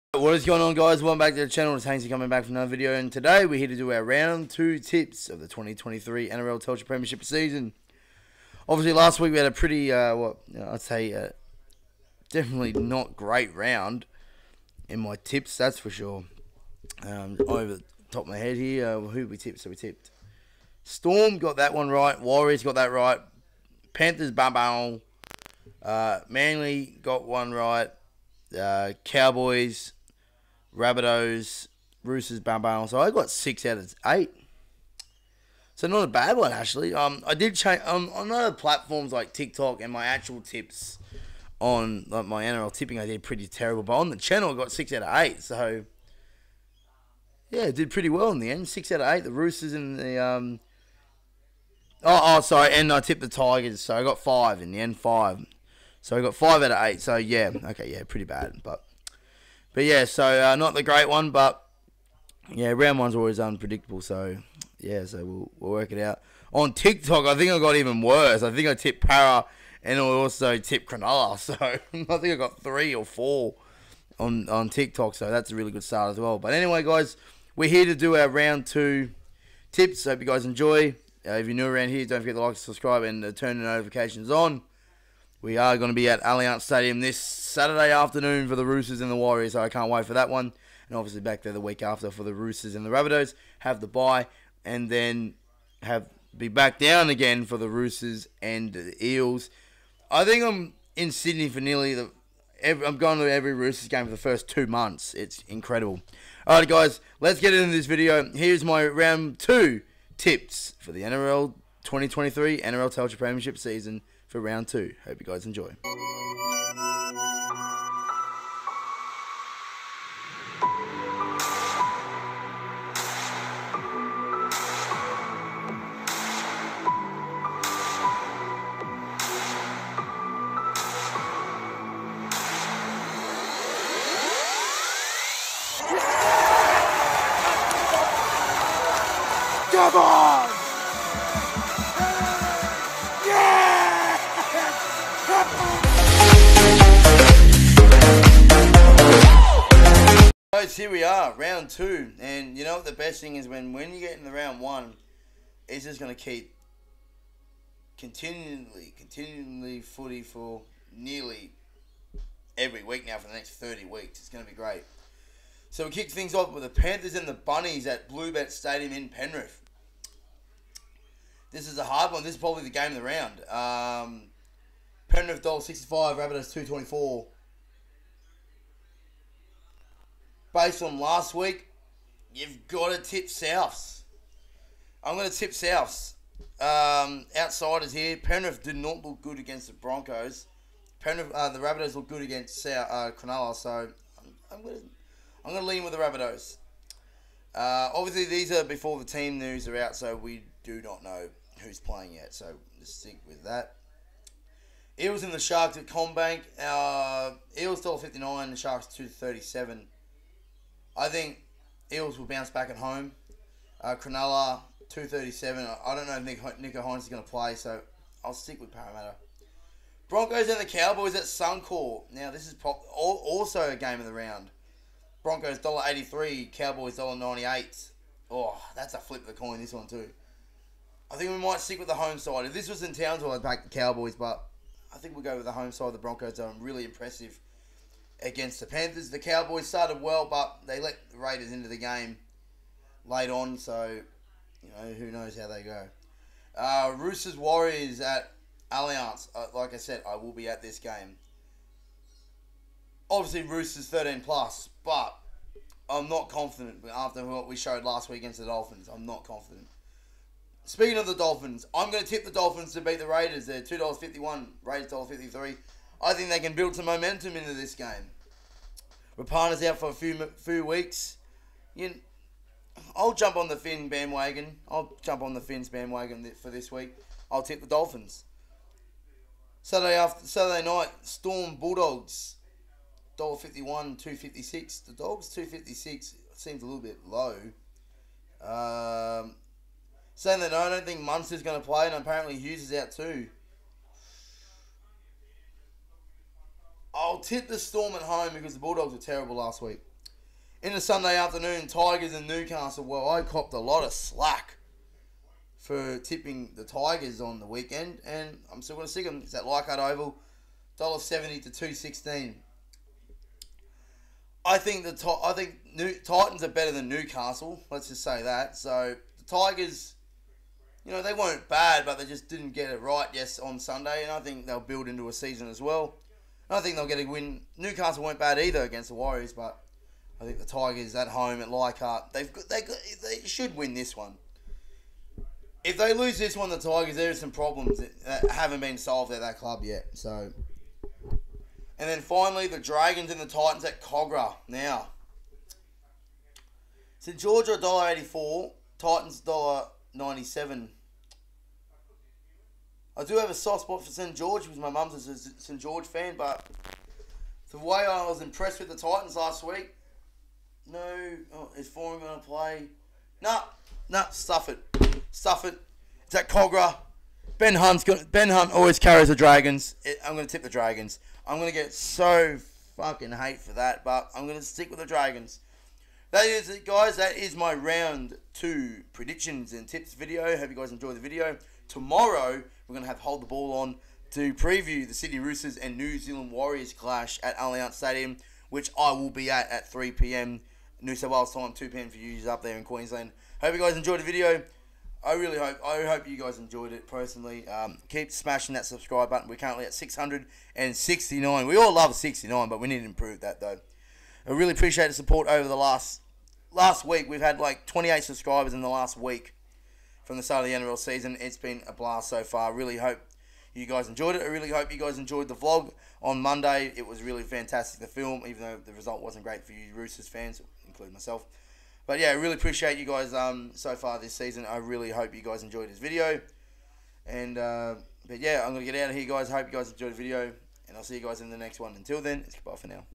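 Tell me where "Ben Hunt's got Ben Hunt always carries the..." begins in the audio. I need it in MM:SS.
06:07.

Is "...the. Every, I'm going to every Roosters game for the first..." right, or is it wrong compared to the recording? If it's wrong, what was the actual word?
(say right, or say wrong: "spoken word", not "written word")
right.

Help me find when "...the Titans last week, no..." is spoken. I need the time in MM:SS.
05:58.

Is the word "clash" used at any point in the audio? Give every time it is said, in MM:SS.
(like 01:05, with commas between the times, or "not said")
06:26.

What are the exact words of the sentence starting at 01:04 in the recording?
So yeah, so we'll, we'll work it out.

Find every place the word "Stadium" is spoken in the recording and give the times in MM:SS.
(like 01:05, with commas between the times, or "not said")
01:26, 02:48, 06:27.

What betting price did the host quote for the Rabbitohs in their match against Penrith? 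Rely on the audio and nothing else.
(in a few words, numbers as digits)
$2.24.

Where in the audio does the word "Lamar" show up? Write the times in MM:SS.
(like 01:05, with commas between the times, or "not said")
not said.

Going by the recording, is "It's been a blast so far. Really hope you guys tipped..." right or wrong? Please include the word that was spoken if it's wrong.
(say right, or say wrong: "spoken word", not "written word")
wrong: "enjoyed", not "tipped".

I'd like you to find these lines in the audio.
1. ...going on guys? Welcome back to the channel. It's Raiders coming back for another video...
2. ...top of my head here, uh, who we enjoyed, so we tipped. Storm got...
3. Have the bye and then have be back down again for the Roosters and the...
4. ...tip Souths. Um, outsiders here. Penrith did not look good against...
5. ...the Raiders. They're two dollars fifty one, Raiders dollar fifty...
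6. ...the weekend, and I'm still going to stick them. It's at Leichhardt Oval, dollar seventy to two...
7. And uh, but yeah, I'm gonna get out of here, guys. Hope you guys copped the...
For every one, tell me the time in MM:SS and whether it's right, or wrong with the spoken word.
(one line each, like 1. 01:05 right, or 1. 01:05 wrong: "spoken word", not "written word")
1. 00:00 wrong: "Haynesy", not "Raiders"
2. 00:18 wrong: "tipped", not "enjoyed"
3. 01:33 right
4. 03:05 right
5. 04:22 right
6. 05:07 right
7. 07:07 wrong: "enjoyed", not "copped".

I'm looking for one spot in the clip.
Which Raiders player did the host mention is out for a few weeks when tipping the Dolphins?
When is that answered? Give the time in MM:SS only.
04:29.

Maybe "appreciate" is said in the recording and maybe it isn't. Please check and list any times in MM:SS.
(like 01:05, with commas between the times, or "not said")
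06:44, 07:02.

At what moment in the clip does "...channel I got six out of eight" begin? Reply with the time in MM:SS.
00:44.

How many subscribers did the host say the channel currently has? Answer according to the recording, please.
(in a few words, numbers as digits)
669.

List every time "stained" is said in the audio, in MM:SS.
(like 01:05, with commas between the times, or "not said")
not said.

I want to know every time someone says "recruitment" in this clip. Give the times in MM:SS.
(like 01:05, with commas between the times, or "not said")
not said.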